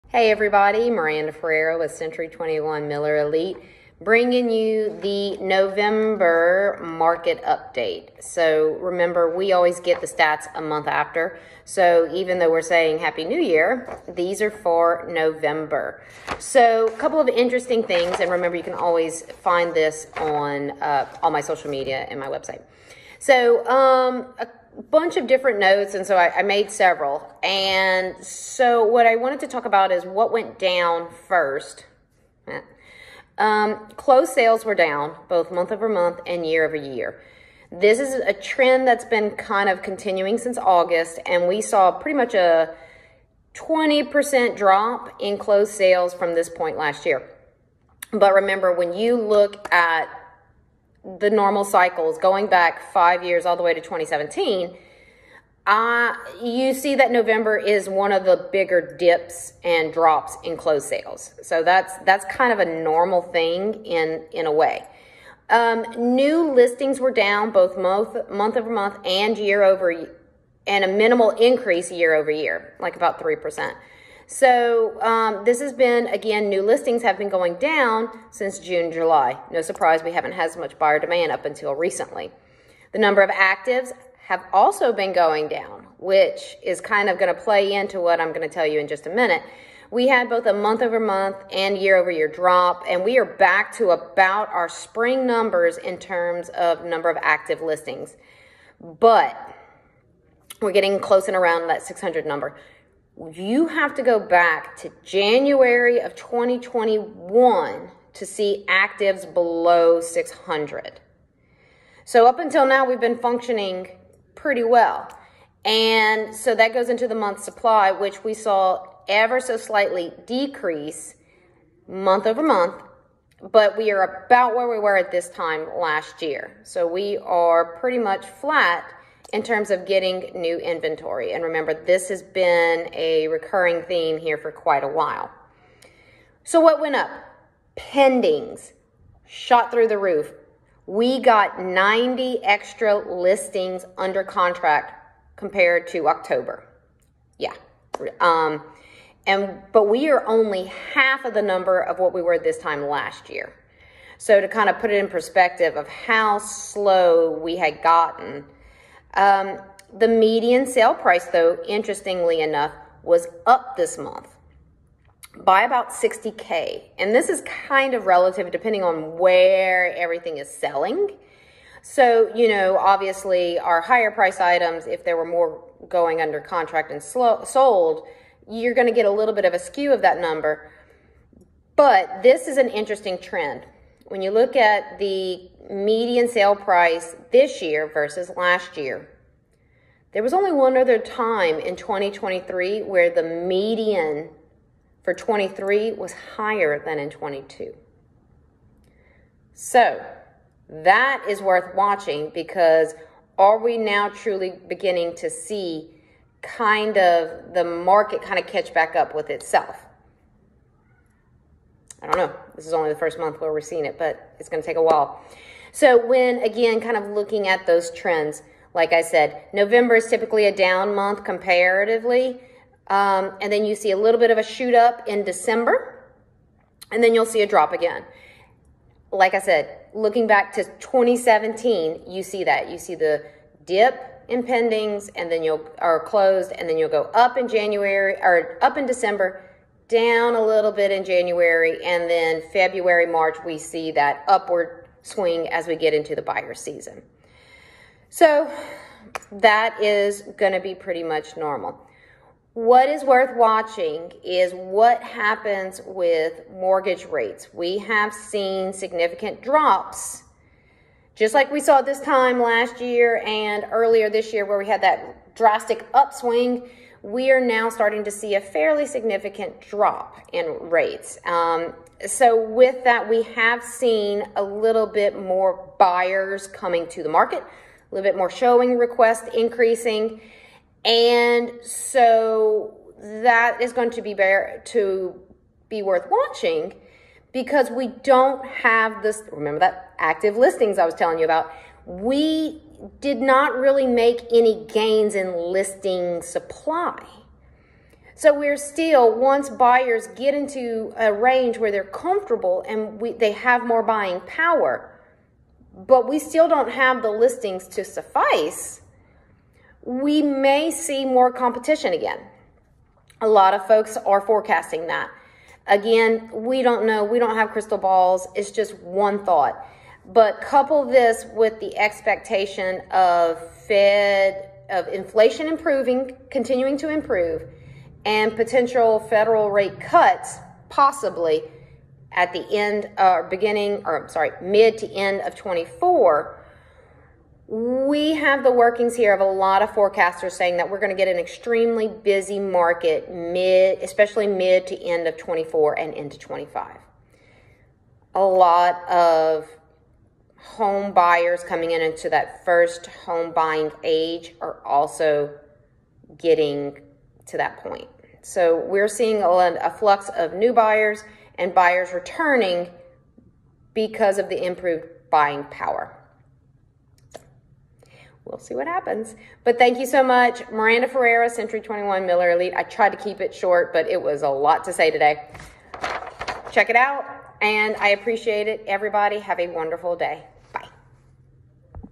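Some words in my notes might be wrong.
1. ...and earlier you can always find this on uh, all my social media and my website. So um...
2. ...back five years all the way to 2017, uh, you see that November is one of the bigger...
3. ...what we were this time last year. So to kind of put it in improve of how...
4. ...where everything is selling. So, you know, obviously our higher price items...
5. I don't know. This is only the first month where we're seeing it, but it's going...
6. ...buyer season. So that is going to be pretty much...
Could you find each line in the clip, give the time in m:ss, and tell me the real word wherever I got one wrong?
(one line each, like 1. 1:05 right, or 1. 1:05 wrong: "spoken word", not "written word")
1. 0:18 wrong: "remember", not "earlier"
2. 0:52 right
3. 2:31 wrong: "perspective", not "improve"
4. 2:49 right
5. 3:32 right
6. 4:06 right.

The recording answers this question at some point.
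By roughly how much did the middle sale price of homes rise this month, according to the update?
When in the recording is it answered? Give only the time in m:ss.
2:45.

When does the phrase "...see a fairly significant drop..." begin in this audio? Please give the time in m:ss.
4:28.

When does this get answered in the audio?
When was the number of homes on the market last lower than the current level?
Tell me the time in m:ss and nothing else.
1:45.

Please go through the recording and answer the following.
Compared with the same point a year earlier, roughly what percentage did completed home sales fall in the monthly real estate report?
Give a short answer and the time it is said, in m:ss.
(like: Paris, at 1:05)
20%, at 0:43.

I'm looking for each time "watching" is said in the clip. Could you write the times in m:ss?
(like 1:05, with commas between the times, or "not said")
3:21, 4:13, 4:46.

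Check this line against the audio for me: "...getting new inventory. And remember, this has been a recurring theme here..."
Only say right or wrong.
right.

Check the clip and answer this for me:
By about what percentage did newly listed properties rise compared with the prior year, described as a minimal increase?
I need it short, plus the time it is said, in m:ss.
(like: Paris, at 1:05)
3%, at 1:13.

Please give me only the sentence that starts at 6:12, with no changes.
I tried to keep it short, but it was a lot to say today.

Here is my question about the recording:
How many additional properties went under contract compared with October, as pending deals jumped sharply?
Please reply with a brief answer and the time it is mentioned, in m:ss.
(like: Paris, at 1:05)
90, at 2:21.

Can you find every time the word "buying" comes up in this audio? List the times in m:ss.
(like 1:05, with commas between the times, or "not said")
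5:03, 5:53, 6:05.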